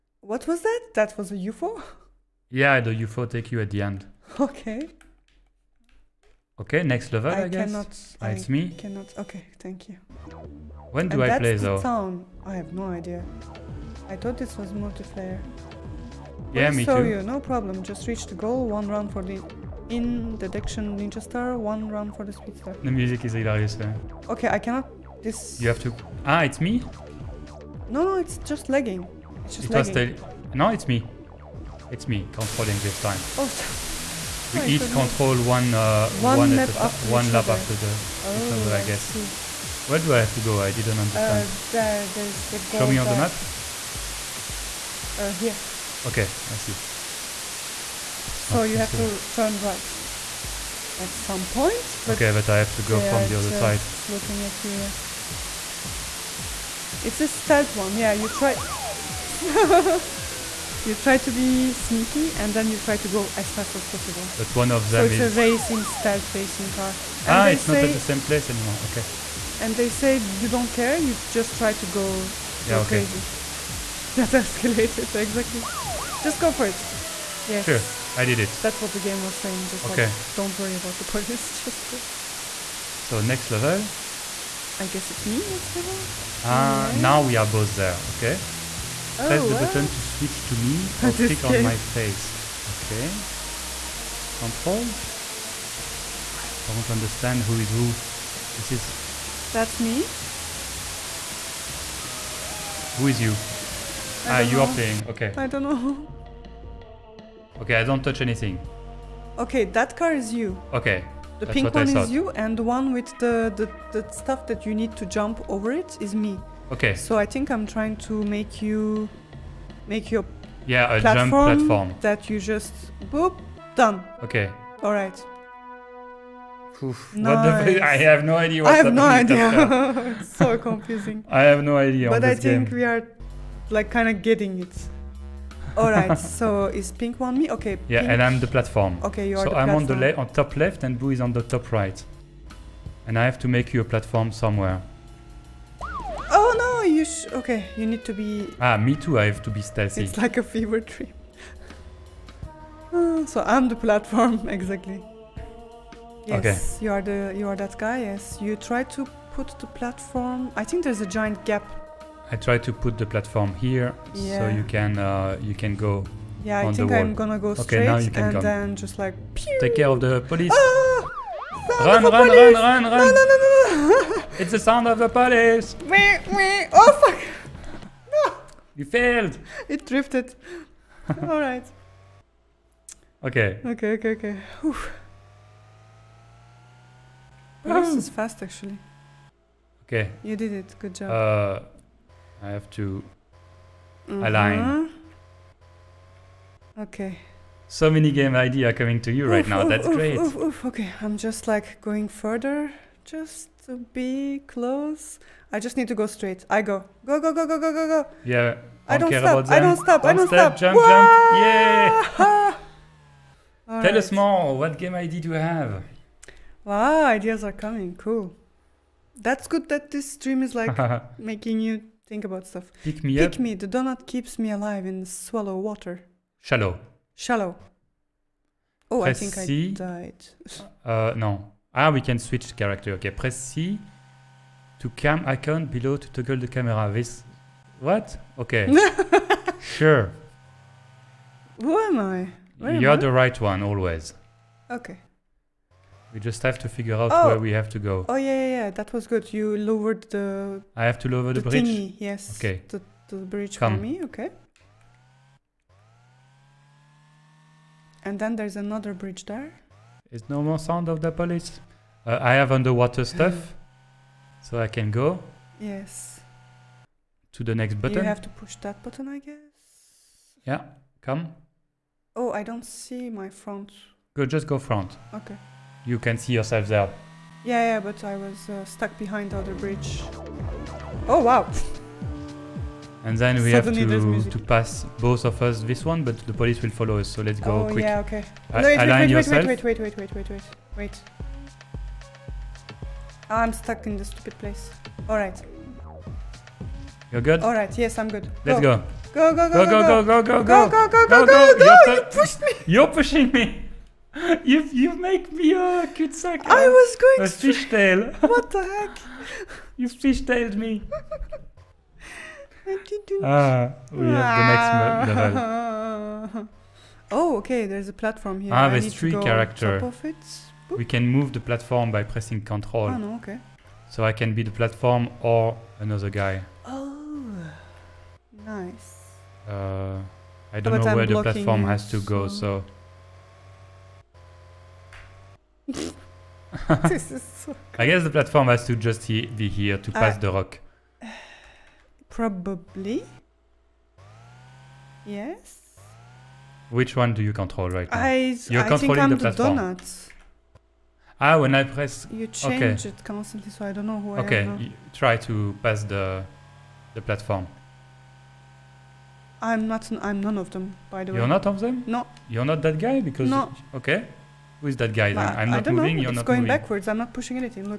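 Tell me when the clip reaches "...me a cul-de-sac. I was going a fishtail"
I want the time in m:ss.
5:05.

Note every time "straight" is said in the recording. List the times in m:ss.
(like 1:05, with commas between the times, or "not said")
2:47, 3:26.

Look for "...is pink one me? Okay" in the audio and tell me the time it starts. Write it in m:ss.
2:16.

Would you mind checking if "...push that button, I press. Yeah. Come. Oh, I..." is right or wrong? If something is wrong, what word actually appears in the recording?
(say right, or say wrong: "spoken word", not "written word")
wrong: "guess", not "press".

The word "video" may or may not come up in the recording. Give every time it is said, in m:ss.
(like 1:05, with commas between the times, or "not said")
not said.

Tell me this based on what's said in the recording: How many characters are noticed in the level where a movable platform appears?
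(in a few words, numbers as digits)
3.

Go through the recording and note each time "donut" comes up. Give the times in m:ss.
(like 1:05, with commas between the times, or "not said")
3:43, 5:49.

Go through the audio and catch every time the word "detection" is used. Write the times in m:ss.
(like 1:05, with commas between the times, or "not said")
0:20.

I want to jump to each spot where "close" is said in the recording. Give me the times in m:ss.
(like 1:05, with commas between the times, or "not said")
3:24.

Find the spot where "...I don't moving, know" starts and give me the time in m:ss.
6:05.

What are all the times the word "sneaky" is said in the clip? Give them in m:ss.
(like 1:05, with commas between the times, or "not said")
1:01.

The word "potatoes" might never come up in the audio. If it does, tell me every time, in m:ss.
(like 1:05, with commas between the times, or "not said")
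not said.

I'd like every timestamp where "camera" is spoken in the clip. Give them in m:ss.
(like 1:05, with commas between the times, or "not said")
3:56.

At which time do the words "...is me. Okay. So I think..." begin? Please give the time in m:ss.
1:56.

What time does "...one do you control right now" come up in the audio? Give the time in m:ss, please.
5:46.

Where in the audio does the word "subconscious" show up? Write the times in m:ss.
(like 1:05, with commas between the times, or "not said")
not said.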